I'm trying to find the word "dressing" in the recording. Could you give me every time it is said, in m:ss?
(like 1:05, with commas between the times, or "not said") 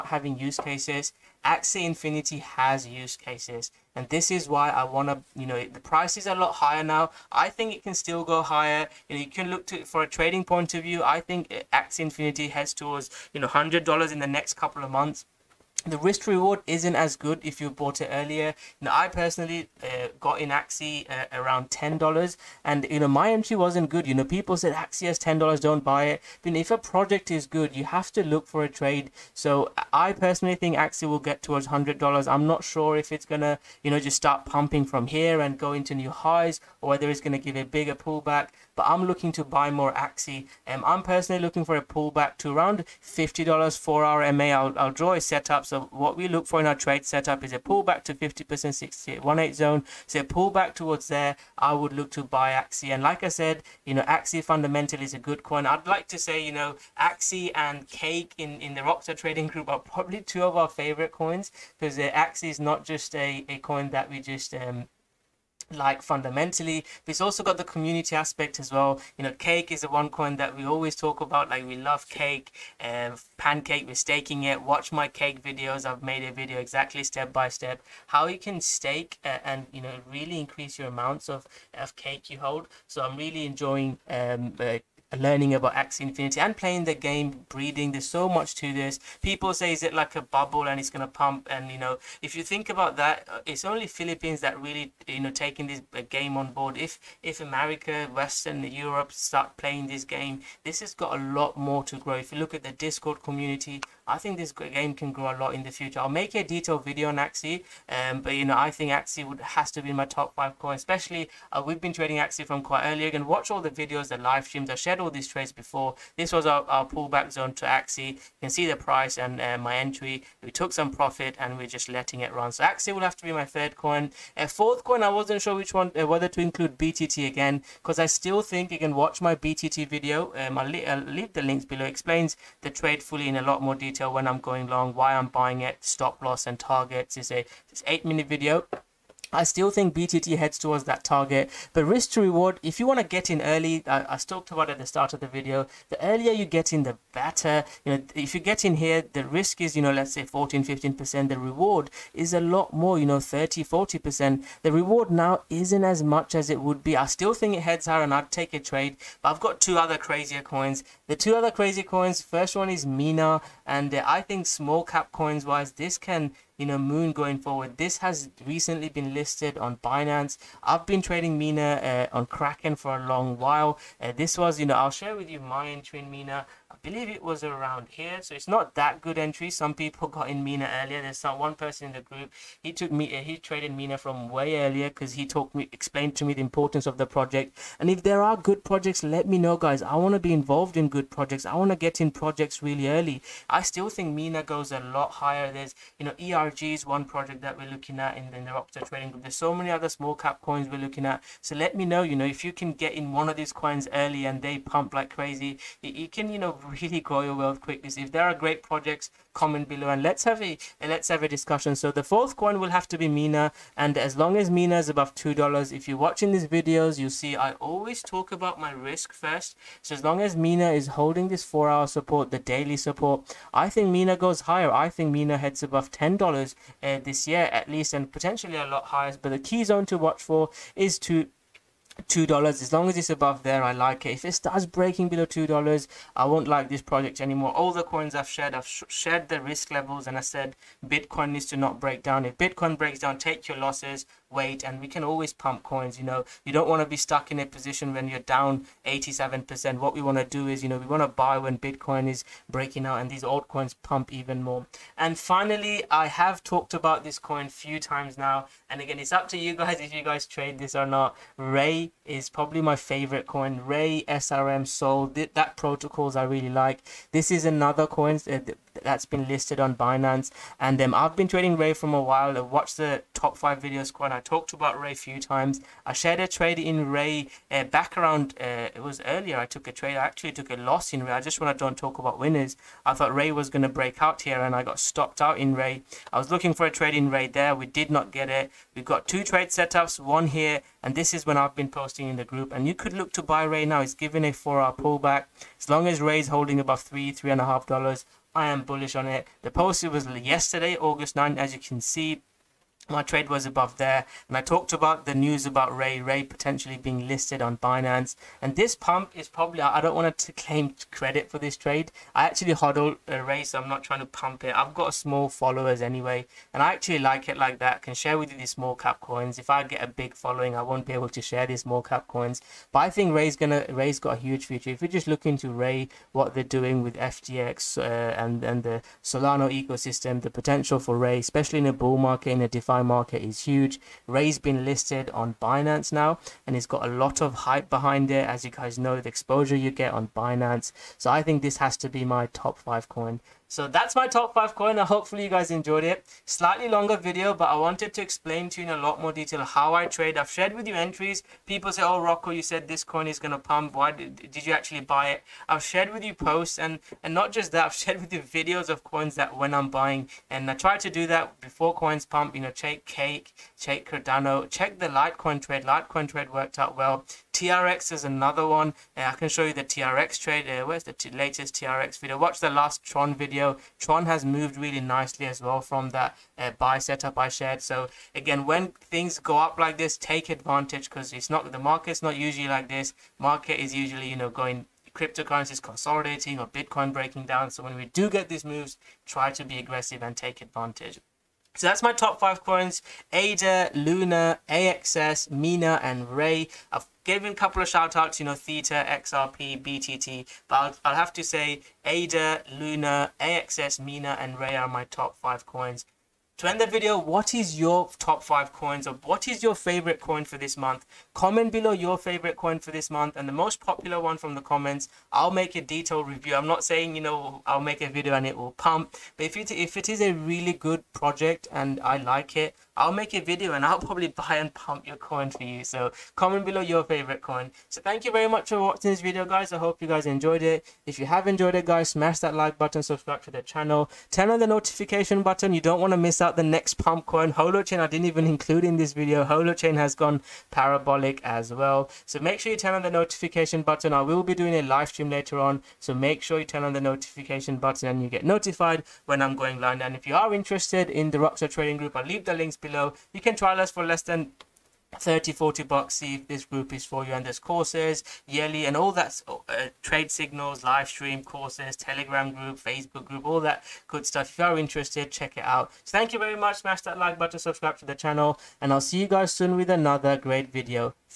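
not said.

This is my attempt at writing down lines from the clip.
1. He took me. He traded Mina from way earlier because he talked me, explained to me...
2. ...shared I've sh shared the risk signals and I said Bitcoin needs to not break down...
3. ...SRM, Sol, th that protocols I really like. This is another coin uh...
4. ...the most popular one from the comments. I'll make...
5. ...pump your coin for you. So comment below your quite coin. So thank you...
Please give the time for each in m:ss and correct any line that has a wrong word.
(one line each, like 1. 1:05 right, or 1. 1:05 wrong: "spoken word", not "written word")
1. 3:02 right
2. 3:58 wrong: "levels", not "signals"
3. 4:24 right
4. 6:53 right
5. 7:04 wrong: "favorite", not "quite".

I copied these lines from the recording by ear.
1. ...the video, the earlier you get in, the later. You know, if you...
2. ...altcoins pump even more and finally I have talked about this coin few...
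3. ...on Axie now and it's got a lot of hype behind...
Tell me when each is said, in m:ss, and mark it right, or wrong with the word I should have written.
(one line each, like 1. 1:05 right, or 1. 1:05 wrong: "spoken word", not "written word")
1. 2:25 wrong: "better", not "later"
2. 4:13 right
3. 5:35 wrong: "Binance", not "Axie".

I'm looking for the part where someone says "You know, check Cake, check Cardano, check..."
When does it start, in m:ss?
6:02.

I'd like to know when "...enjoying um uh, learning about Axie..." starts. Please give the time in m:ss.
1:23.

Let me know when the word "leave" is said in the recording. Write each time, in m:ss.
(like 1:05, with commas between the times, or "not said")
2:10, 7:32.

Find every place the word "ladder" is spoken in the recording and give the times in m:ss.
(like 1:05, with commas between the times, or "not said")
not said.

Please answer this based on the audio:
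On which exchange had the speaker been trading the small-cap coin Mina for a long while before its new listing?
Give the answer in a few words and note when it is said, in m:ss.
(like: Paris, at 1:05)
Kraken, at 2:52.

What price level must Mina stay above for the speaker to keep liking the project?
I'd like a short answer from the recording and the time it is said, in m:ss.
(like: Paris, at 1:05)
$2, at 3:35.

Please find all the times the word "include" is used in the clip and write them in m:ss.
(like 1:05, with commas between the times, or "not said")
2:06, 7:18.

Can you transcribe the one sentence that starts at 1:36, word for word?
If, if America, Western Europe start playing this game, this has got a lot more to grow.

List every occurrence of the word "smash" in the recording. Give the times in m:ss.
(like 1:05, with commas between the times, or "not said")
7:11, 7:46.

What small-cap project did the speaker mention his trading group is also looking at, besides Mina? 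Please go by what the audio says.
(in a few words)
ERG.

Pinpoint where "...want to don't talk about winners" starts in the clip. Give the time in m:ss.
4:41.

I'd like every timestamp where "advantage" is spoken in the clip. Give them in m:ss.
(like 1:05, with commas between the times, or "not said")
6:20, 6:30.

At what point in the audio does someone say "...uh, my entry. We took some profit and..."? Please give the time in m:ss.
1:59.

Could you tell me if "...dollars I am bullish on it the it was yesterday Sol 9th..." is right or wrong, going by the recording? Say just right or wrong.
wrong.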